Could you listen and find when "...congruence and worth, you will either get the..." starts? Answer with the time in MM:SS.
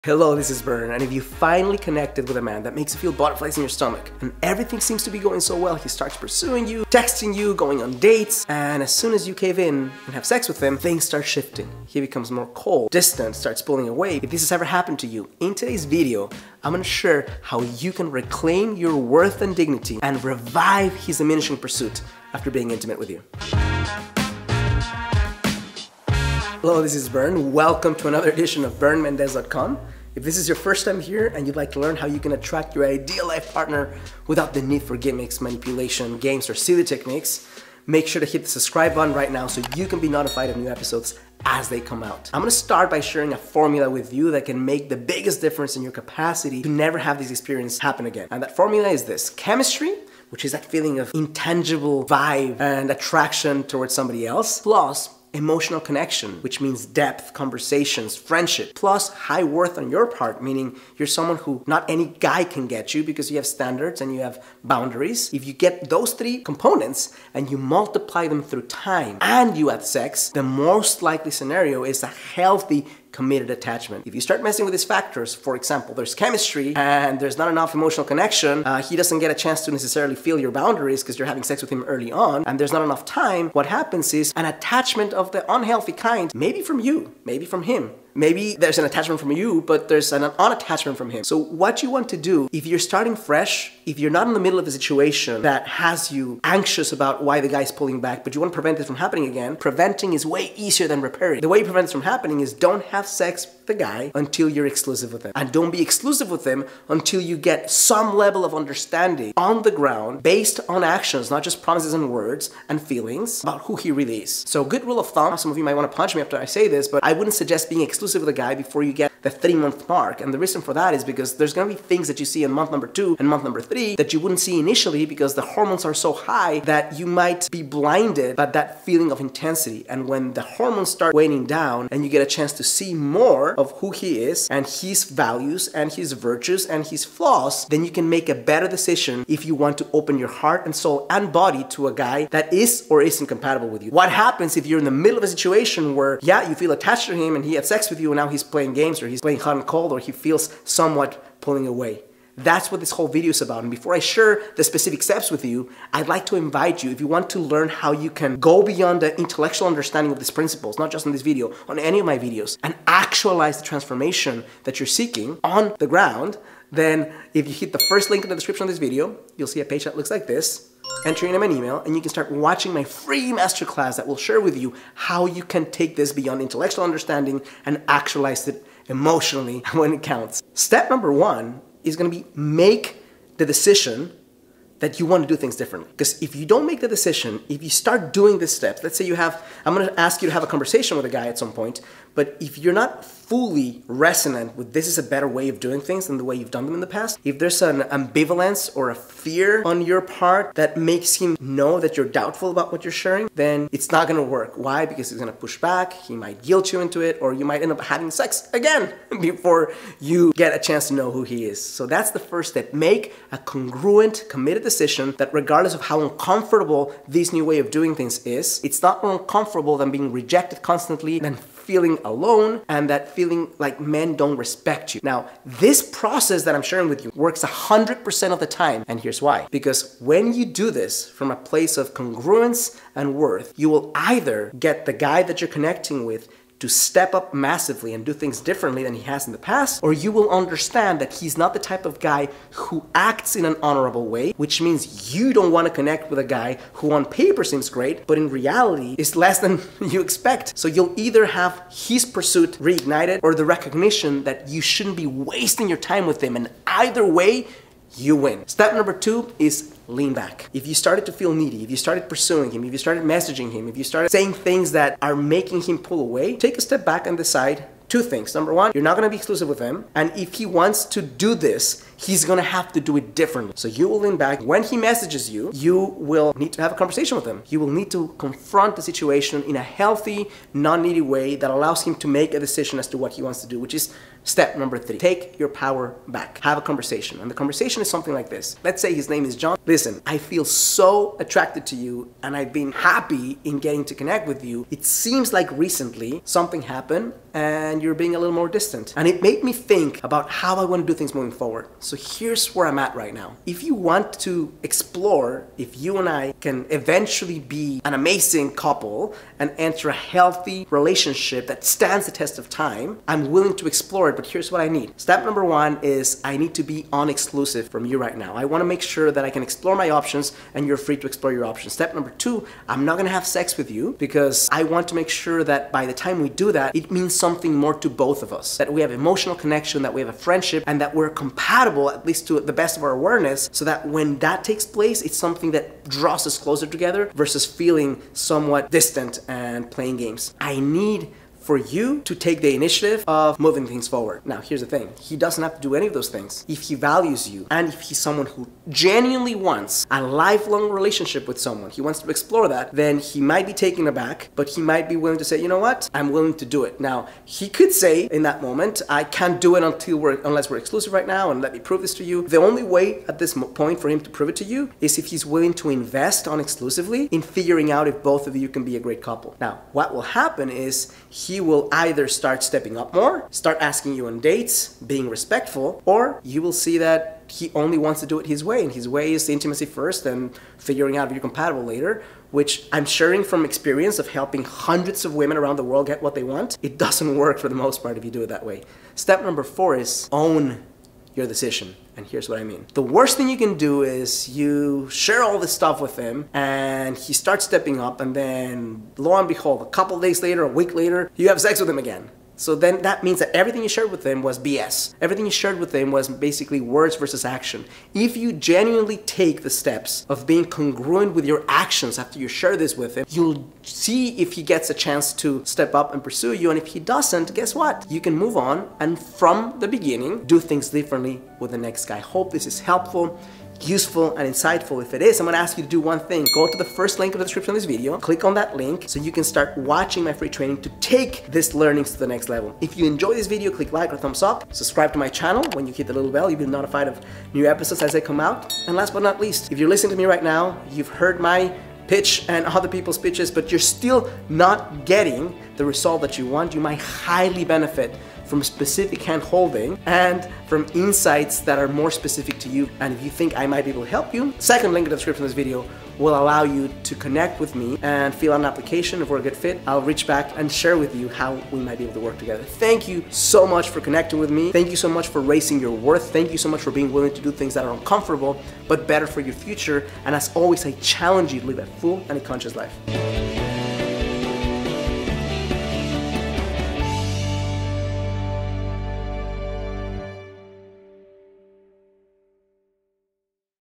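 03:51.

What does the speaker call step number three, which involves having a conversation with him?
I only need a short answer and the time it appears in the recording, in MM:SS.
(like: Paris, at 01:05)
Take your power back, at 04:44.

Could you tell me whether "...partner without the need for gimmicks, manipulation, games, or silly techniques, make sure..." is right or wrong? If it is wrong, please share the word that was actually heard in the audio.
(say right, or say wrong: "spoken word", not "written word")
right.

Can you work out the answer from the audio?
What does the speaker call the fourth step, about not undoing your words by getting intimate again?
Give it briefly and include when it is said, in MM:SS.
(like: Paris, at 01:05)
Own your decision, at 06:30.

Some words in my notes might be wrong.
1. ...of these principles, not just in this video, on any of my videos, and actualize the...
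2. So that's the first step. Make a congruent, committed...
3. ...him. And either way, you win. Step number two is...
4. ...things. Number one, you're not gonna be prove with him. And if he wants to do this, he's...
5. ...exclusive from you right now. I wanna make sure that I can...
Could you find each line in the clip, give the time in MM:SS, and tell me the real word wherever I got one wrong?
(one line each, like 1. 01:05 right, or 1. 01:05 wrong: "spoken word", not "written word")
1. 02:40 right
2. 03:31 right
3. 04:16 right
4. 04:28 wrong: "exclusive", not "prove"
5. 05:16 wrong: "unexclusive", not "exclusive".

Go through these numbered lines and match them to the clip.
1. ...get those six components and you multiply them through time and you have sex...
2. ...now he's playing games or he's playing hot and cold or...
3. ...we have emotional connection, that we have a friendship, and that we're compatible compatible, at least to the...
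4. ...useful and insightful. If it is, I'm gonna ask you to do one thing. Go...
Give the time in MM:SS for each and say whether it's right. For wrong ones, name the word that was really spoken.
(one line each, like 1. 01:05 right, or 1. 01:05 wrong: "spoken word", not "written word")
1. 01:05 wrong: "three", not "six"
2. 02:28 right
3. 05:28 right
4. 07:03 right.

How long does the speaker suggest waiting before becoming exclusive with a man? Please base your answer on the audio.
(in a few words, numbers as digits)
3 months.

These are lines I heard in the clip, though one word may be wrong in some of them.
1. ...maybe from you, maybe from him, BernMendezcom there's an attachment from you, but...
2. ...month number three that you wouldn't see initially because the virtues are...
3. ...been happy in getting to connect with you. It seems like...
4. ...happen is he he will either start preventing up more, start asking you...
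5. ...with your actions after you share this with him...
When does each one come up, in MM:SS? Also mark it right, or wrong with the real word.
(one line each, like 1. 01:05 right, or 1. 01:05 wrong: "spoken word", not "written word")
1. 01:26 wrong: "Maybe", not "BernMendezcom"
2. 02:03 wrong: "hormones", not "virtues"
3. 04:52 right
4. 06:10 wrong: "stepping", not "preventing"
5. 06:51 right.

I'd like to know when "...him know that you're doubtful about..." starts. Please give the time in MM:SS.
03:21.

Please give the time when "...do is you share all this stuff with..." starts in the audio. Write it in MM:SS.
06:33.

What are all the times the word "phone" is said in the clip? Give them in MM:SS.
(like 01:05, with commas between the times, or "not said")
not said.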